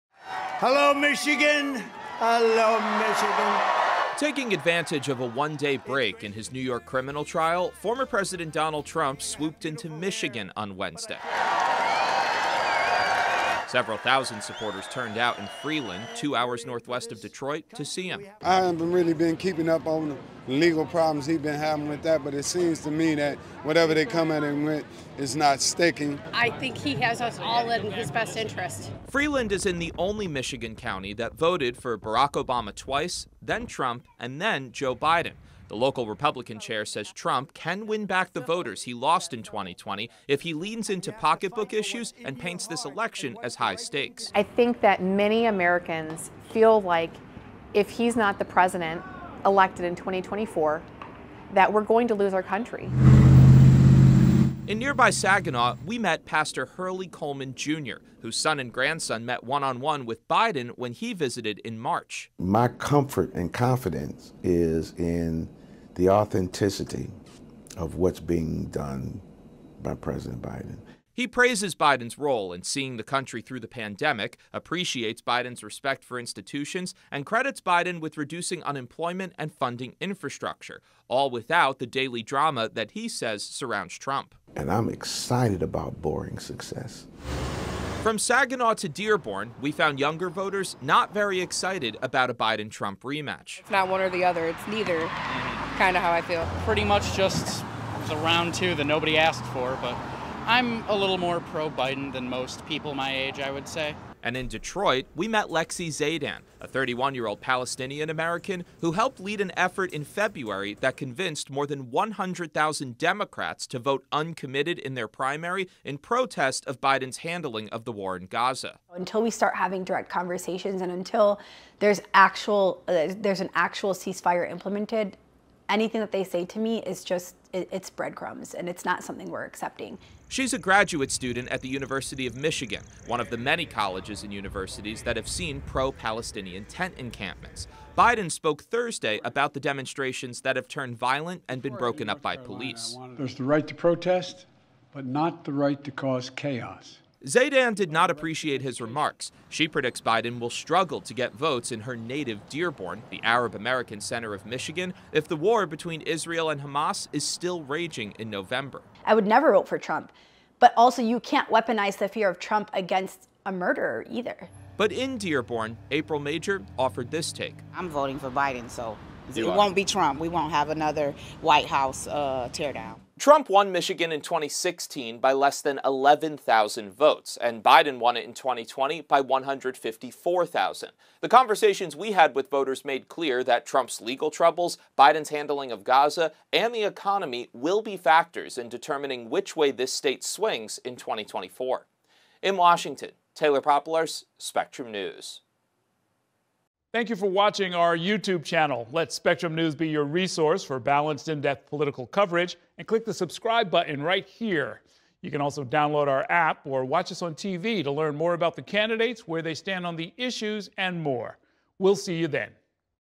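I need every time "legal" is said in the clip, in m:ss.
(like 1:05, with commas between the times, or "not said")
0:20, 3:04.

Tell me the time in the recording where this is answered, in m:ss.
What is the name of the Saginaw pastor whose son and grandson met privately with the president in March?
0:56.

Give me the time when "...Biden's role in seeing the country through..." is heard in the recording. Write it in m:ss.
1:11.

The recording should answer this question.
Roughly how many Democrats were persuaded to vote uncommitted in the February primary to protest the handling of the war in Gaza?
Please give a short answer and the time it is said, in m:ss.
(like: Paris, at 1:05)
more than 100,000, at 1:51.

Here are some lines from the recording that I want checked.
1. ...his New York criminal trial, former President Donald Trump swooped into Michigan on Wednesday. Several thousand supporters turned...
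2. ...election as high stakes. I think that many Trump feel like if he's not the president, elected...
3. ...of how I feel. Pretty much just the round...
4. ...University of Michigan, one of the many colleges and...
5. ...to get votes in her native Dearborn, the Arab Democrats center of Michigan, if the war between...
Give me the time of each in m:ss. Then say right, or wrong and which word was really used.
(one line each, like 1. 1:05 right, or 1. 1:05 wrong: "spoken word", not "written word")
1. 0:06 right
2. 0:42 wrong: "Americans", not "Trump"
3. 1:35 right
4. 2:11 right
5. 2:31 wrong: "American", not "Democrats".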